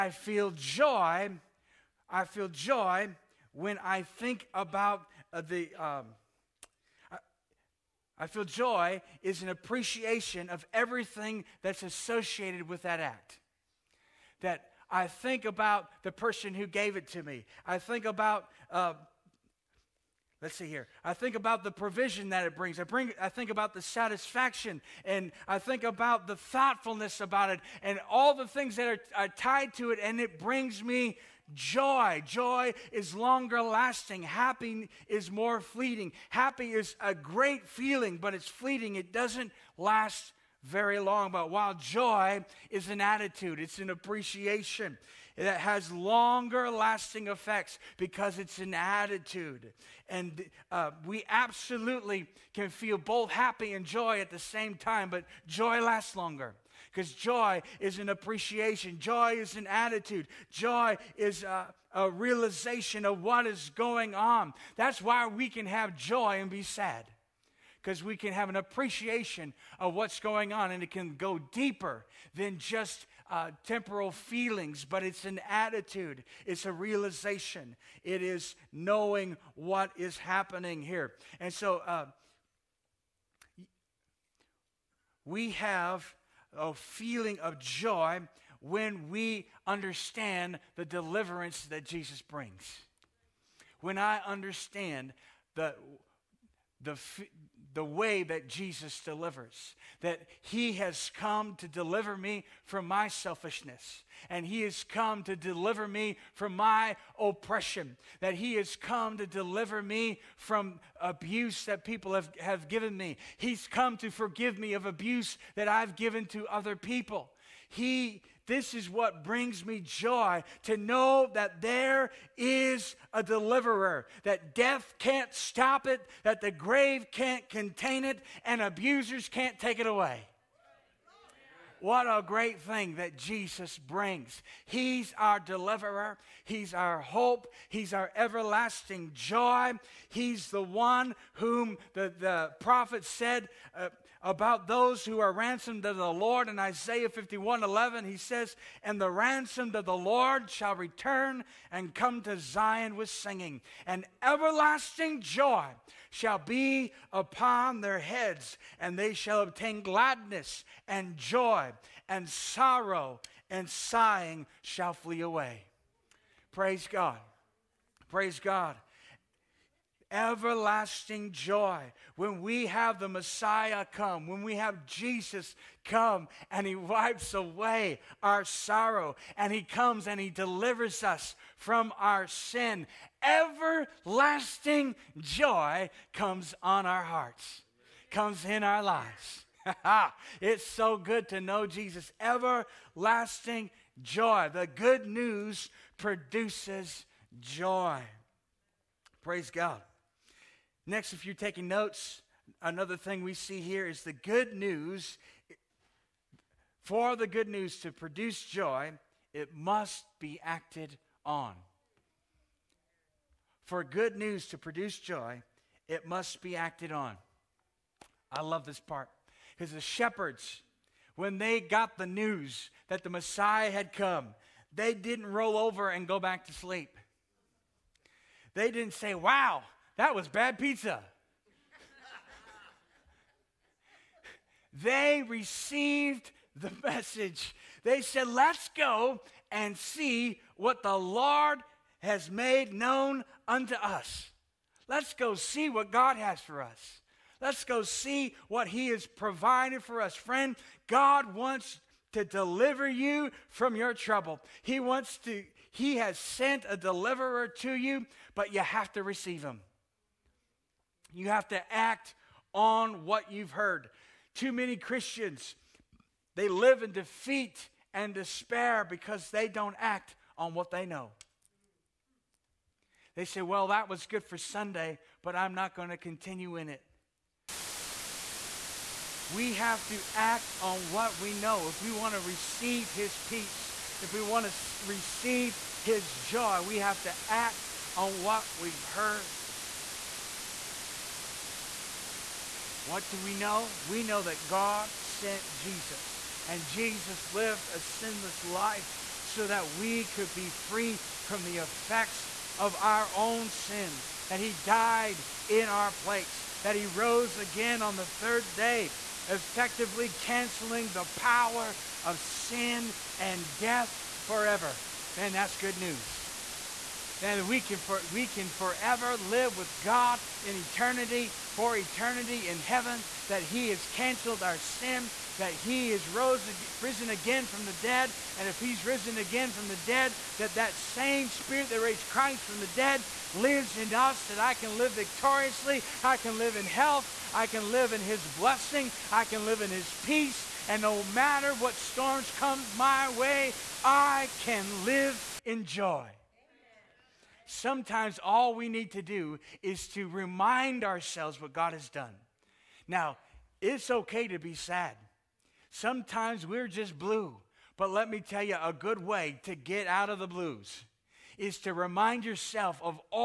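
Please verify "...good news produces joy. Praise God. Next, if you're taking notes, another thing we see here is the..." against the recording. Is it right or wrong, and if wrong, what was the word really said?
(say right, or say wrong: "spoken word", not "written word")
right.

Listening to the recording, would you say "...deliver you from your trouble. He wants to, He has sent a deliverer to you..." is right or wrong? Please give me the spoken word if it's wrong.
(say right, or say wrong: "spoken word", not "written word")
right.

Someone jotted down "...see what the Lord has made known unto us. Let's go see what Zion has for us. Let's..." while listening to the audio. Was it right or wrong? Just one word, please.
wrong.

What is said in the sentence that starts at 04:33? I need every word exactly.
They say, Well, that was good for Sunday, but I'm not going to continue in it.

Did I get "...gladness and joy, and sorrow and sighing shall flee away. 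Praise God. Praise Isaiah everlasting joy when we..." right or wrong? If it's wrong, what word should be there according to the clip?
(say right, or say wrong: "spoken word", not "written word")
wrong: "God", not "Isaiah".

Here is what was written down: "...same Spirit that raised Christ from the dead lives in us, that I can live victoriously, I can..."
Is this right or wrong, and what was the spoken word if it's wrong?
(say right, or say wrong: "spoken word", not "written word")
right.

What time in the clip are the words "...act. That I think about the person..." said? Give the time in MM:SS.
00:12.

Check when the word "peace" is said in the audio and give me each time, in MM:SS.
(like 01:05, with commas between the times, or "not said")
04:43, 05:40.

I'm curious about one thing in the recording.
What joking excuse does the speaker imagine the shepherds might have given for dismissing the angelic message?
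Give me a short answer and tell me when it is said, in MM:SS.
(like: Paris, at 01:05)
bad pizza, at 03:50.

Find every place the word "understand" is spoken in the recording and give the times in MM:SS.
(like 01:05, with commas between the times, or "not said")
01:29, 01:34.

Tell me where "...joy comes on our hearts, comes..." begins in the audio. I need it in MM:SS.
03:05.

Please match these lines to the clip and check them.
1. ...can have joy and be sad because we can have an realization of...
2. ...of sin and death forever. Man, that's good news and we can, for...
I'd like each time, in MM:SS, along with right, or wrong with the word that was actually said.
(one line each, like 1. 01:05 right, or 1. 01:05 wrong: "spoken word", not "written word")
1. 01:05 wrong: "appreciation", not "realization"
2. 05:12 right.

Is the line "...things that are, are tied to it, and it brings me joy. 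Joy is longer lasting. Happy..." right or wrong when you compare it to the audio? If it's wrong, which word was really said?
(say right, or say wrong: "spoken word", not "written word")
right.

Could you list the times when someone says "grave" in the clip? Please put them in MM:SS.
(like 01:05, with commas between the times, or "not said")
02:06.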